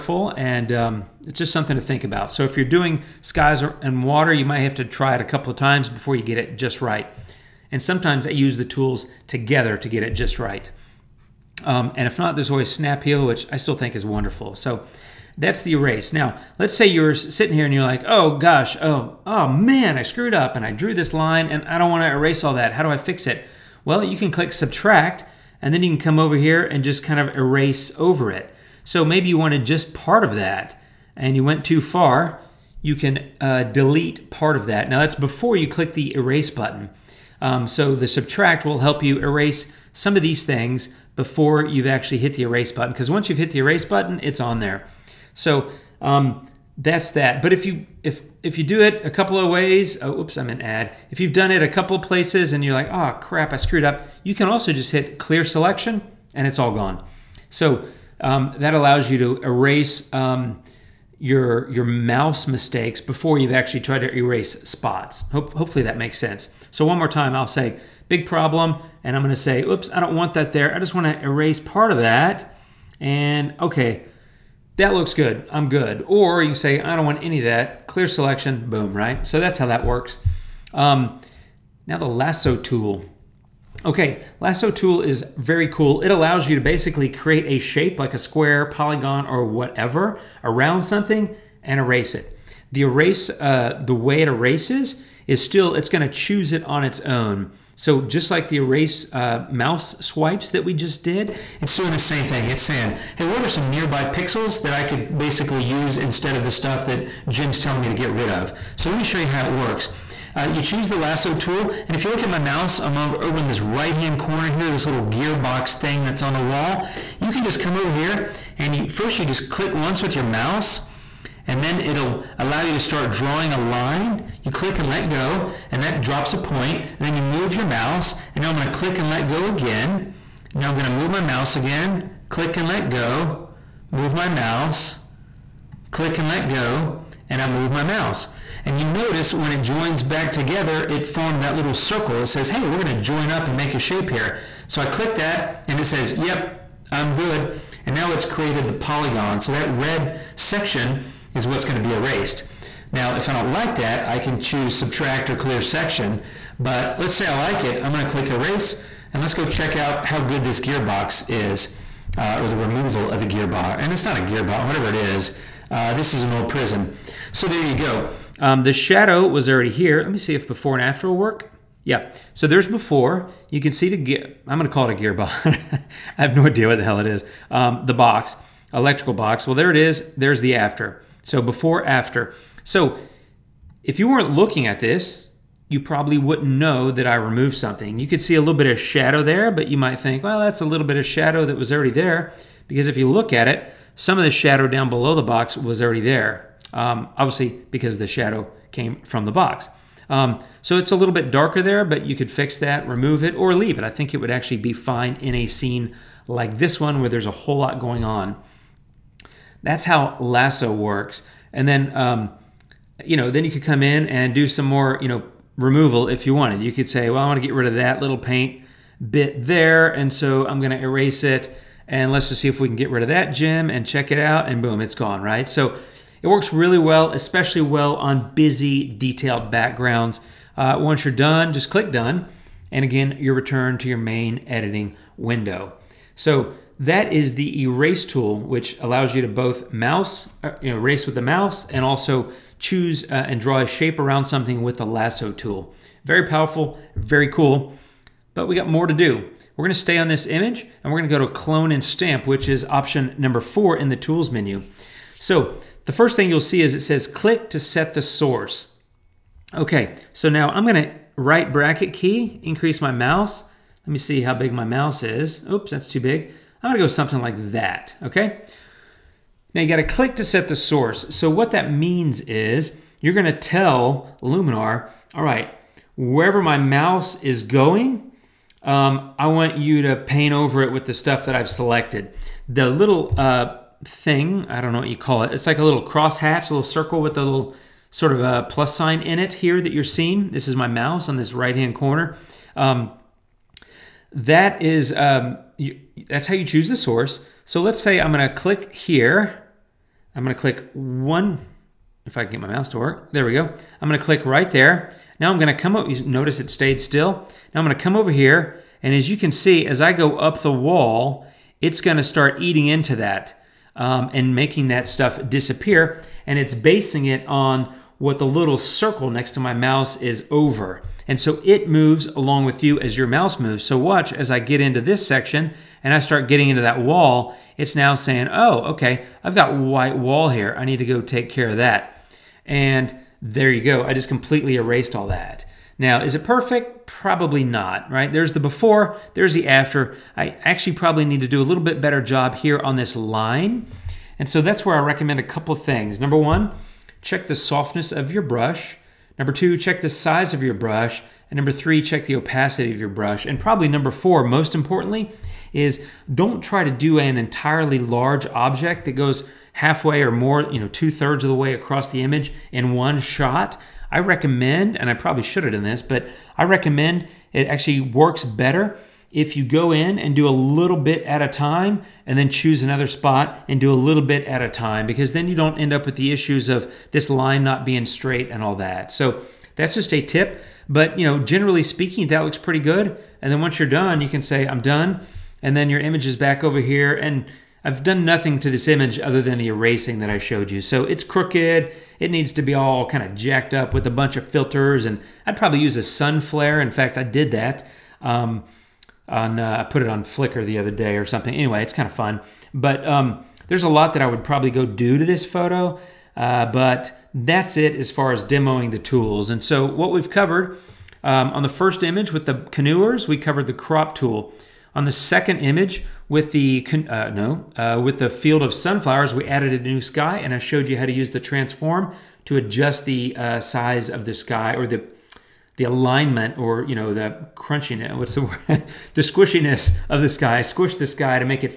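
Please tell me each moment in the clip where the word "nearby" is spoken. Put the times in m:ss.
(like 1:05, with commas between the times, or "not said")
1:43.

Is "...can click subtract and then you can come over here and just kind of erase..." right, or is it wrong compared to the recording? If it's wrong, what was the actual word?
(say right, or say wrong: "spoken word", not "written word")
right.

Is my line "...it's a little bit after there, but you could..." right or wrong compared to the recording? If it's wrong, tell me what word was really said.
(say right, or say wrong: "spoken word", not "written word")
wrong: "darker", not "after".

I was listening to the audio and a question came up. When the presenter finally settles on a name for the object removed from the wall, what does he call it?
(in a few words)
Electrical box.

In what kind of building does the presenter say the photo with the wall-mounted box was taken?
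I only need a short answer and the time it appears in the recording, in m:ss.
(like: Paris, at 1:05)
An old prison, at 2:46.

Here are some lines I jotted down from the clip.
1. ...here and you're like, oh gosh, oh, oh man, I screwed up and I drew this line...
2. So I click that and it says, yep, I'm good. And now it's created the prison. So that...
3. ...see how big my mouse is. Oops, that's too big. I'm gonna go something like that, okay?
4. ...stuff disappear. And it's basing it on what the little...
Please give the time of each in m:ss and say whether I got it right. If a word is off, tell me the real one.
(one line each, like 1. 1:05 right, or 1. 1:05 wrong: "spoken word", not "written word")
1. 0:17 right
2. 2:24 wrong: "polygon", not "prison"
3. 4:23 right
4. 5:14 right.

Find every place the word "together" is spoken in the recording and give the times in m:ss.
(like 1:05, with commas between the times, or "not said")
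0:09, 2:20.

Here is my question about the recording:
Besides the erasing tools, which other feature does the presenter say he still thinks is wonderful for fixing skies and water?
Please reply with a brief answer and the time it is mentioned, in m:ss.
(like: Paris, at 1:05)
Snap heal, at 0:12.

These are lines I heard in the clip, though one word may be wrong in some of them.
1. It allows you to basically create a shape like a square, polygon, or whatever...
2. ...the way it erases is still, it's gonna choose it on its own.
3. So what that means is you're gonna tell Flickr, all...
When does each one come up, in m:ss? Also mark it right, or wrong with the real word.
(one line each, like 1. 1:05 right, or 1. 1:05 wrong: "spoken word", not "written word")
1. 1:25 right
2. 1:33 right
3. 4:31 wrong: "Luminar", not "Flickr".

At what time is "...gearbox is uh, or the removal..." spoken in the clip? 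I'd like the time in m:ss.
2:40.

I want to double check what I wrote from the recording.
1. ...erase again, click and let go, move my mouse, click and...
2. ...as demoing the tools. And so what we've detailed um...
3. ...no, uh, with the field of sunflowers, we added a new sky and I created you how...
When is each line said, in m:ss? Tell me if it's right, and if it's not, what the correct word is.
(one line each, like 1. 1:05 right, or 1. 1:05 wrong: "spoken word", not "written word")
1. 2:11 wrong: "mouse", not "erase"
2. 6:48 wrong: "covered", not "detailed"
3. 6:57 wrong: "showed", not "created".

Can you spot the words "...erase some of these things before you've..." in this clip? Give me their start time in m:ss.
0:39.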